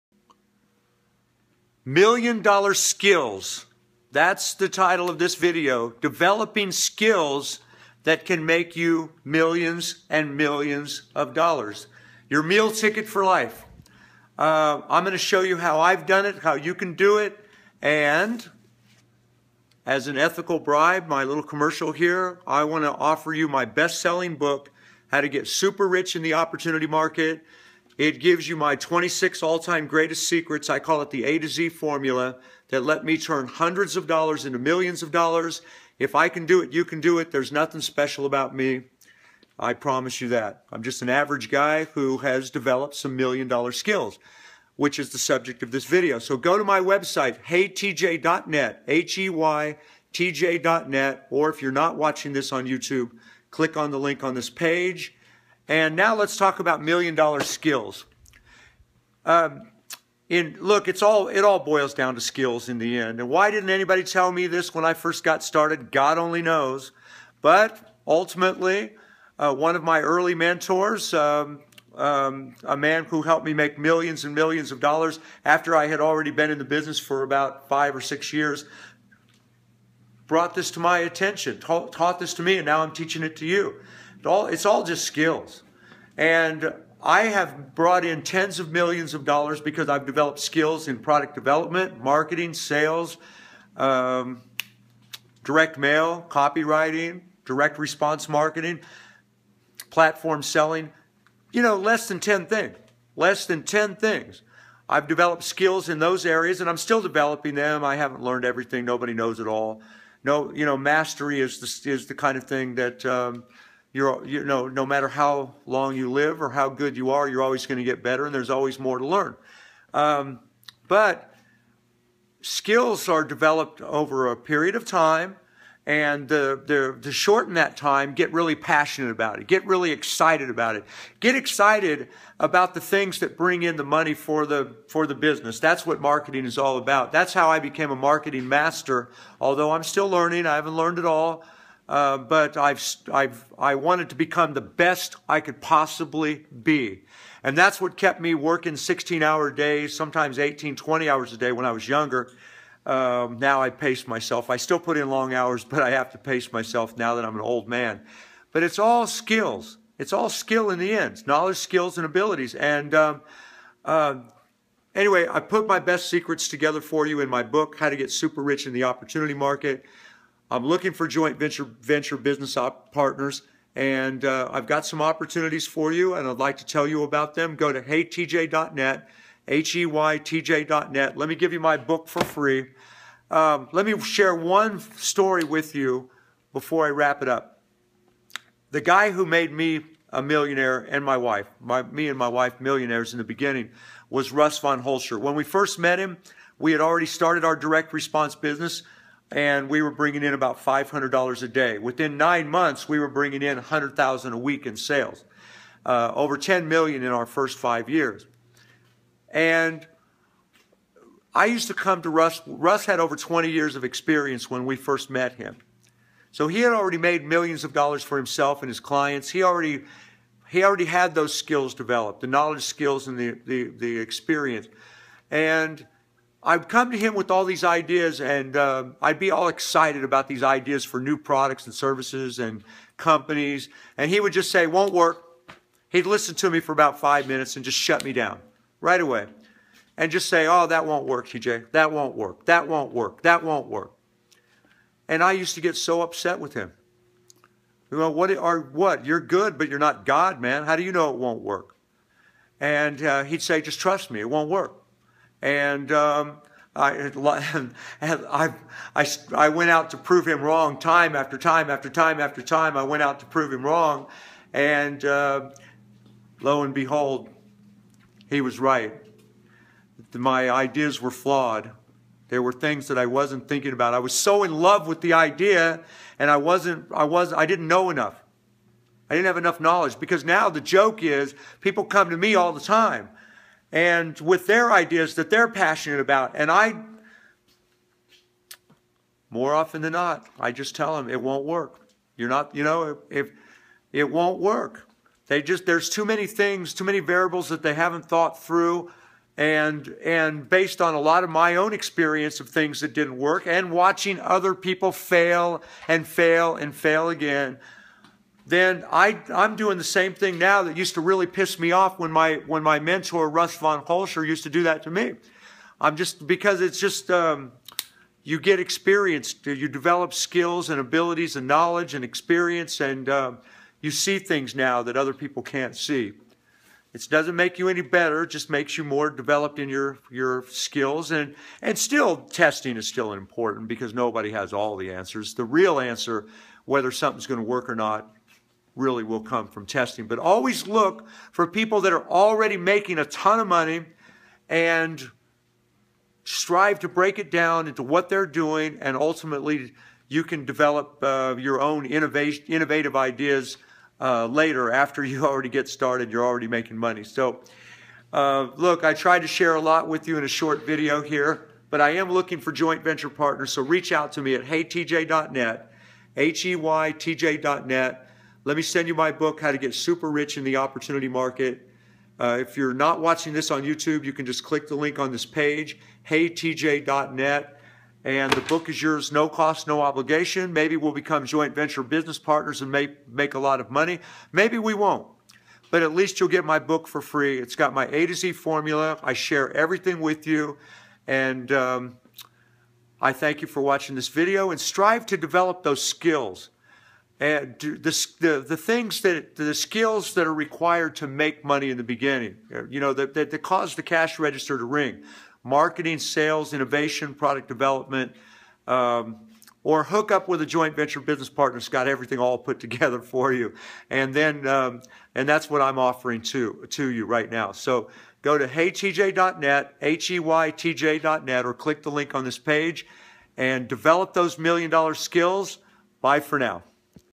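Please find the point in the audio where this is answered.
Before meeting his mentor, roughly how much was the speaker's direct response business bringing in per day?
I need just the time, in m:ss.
3:20.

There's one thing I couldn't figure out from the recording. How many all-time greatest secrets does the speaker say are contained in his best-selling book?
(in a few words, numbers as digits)
26.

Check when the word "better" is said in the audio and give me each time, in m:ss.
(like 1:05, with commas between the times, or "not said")
1:58, 5:27.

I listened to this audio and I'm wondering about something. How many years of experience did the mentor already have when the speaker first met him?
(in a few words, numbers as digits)
over 20.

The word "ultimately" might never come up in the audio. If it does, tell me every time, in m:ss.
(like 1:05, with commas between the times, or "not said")
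1:08, 5:48.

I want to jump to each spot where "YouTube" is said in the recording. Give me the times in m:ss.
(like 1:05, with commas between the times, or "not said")
0:52, 6:13.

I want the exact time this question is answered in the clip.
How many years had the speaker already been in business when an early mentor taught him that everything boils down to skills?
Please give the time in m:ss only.
1:17.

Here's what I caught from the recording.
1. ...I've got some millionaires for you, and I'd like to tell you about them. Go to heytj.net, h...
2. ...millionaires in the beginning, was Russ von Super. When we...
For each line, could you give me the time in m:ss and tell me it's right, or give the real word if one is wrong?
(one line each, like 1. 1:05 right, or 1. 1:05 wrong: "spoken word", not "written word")
1. 2:54 wrong: "opportunities", not "millionaires"
2. 3:12 wrong: "Hoelscher", not "Super".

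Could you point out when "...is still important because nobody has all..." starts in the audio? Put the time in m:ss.
5:32.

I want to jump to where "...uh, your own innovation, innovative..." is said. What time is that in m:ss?
5:51.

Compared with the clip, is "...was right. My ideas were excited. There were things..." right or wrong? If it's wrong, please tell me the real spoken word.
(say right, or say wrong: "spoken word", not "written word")
wrong: "flawed", not "excited".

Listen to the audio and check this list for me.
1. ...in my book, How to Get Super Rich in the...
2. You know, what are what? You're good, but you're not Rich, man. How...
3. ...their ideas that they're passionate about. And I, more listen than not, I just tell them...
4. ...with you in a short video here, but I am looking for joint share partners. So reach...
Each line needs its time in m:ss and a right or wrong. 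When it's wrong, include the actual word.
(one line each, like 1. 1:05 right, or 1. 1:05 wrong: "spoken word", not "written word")
1. 2:47 right
2. 4:07 wrong: "God", not "Rich"
3. 4:44 wrong: "often", not "listen"
4. 5:59 wrong: "venture", not "share".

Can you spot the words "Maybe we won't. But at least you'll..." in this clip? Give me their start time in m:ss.
6:24.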